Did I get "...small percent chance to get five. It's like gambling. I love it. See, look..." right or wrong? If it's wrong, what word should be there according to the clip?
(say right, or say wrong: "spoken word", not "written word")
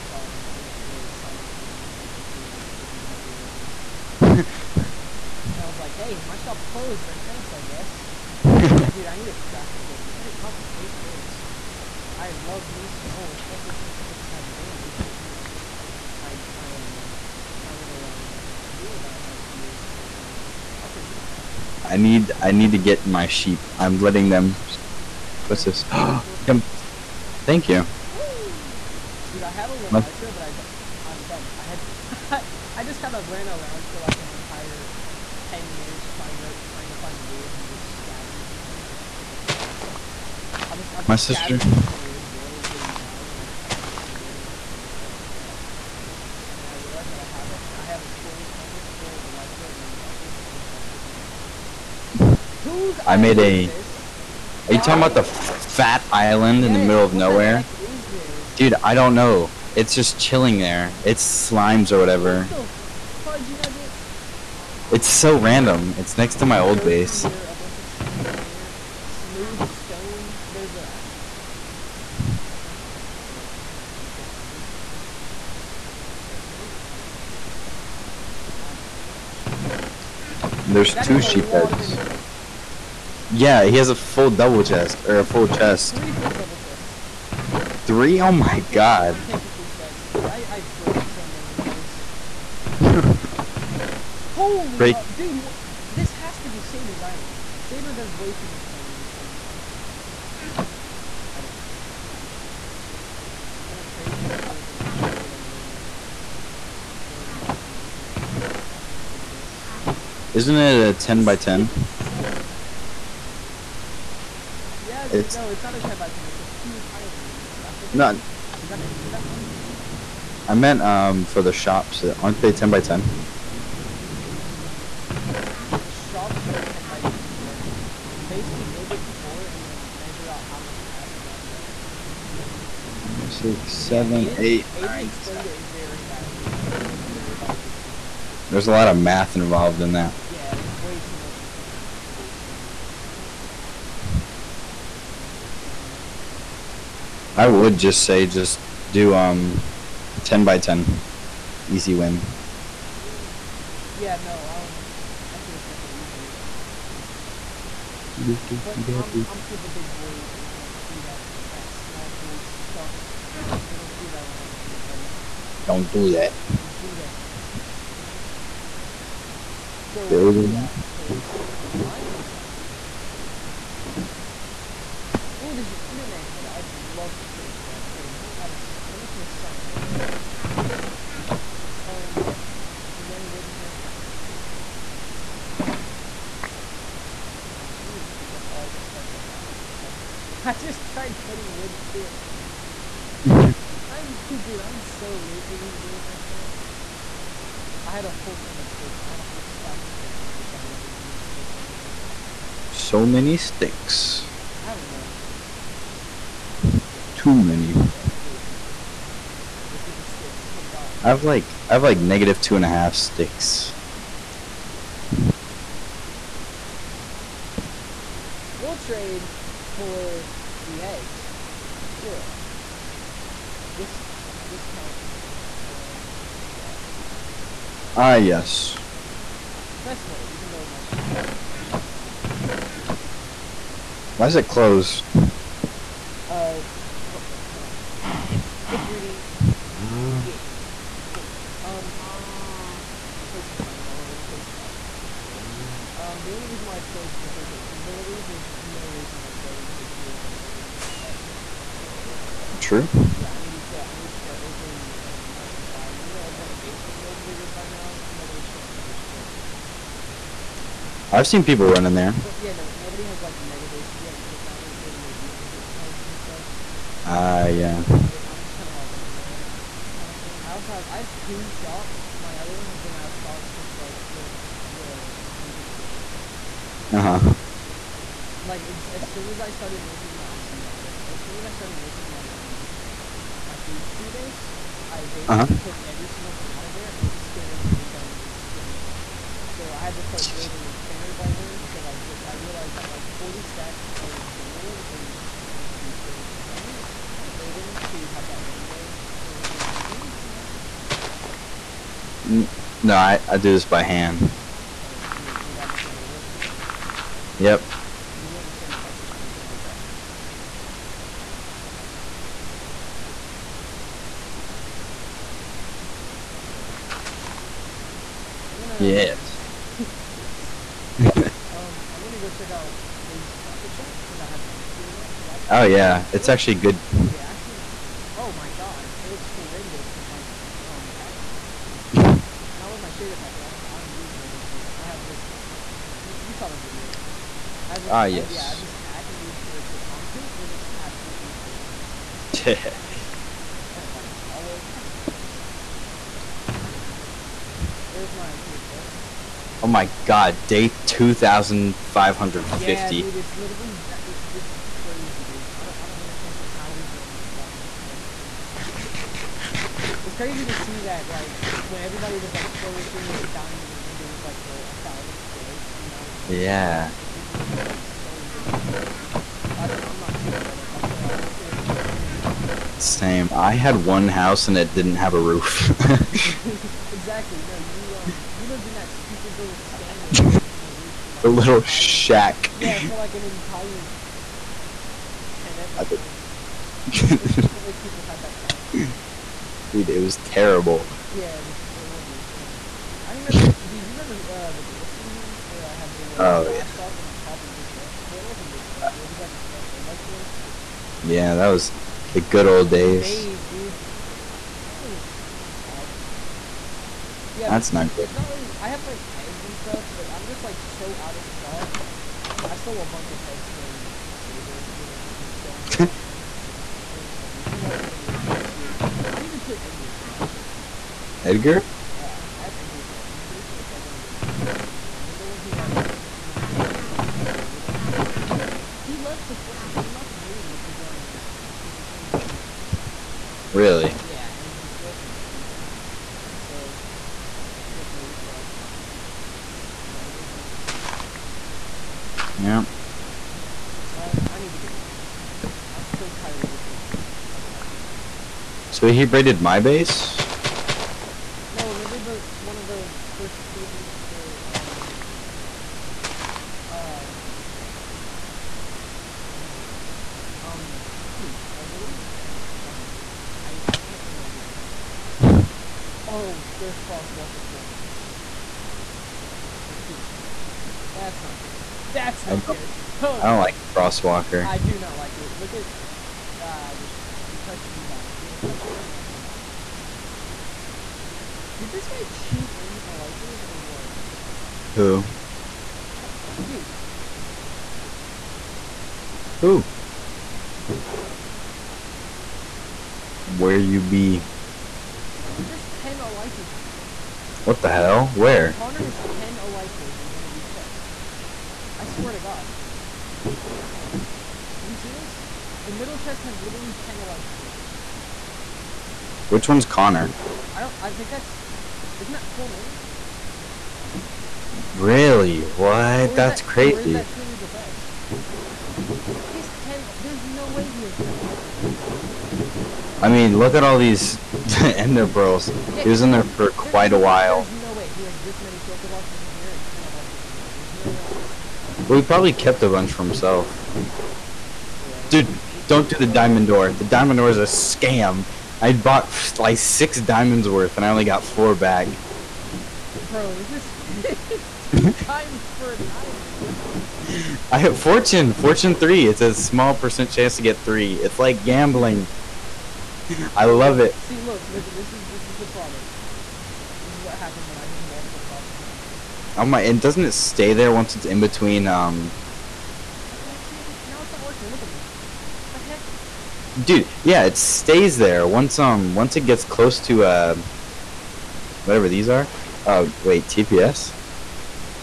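wrong: "three", not "five".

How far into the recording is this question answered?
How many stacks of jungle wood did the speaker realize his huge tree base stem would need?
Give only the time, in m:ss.
4:53.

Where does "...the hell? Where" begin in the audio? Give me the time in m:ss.
8:17.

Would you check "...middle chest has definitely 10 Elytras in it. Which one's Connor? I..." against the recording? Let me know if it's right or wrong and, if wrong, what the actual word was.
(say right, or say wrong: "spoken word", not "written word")
wrong: "literally", not "definitely".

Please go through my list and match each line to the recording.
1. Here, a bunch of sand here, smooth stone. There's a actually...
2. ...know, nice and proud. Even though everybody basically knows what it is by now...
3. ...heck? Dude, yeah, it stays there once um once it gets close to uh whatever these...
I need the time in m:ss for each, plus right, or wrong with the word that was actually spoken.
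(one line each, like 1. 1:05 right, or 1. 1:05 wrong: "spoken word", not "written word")
1. 1:07 right
2. 4:15 right
3. 9:25 right.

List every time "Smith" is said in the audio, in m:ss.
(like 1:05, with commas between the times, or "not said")
not said.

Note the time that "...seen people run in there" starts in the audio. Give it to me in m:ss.
4:21.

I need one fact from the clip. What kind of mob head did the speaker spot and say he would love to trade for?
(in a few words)
Enderman head.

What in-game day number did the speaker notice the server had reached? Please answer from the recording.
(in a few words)
2,550.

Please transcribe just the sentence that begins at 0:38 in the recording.
I'm gonna pick up all this.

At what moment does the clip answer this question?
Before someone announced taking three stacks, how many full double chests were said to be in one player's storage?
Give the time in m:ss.
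1:25.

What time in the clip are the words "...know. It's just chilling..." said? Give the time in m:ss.
0:59.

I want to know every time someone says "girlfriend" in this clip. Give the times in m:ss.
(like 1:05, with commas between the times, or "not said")
7:14.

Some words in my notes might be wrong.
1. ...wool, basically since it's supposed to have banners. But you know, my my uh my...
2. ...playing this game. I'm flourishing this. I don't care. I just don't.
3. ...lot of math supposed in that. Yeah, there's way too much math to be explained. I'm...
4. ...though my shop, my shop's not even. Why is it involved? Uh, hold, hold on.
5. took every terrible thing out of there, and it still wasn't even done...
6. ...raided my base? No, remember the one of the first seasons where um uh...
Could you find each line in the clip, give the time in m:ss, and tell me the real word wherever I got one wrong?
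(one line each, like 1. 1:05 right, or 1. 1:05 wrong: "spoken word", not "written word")
1. 0:13 wrong: "especially", not "basically"
2. 1:38 wrong: "taking", not "flourishing"
3. 2:18 wrong: "involved", not "supposed"
4. 3:50 wrong: "closed", not "involved"
5. 4:45 wrong: "single", not "terrible"
6. 7:29 right.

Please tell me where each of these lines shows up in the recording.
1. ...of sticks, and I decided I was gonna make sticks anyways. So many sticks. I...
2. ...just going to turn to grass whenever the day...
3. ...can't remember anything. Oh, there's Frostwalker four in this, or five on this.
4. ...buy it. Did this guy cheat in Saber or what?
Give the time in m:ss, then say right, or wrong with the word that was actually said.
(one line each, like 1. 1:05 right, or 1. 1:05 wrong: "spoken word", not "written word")
1. 3:19 right
2. 5:09 right
3. 7:43 wrong: "two", not "five"
4. 7:59 wrong: "Elytras", not "Saber".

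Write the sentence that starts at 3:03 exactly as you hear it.
Yeah, I'm gonna take two things.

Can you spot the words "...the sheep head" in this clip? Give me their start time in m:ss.
1:17.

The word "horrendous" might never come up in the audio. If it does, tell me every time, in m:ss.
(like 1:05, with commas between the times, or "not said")
5:29, 6:31, 7:39.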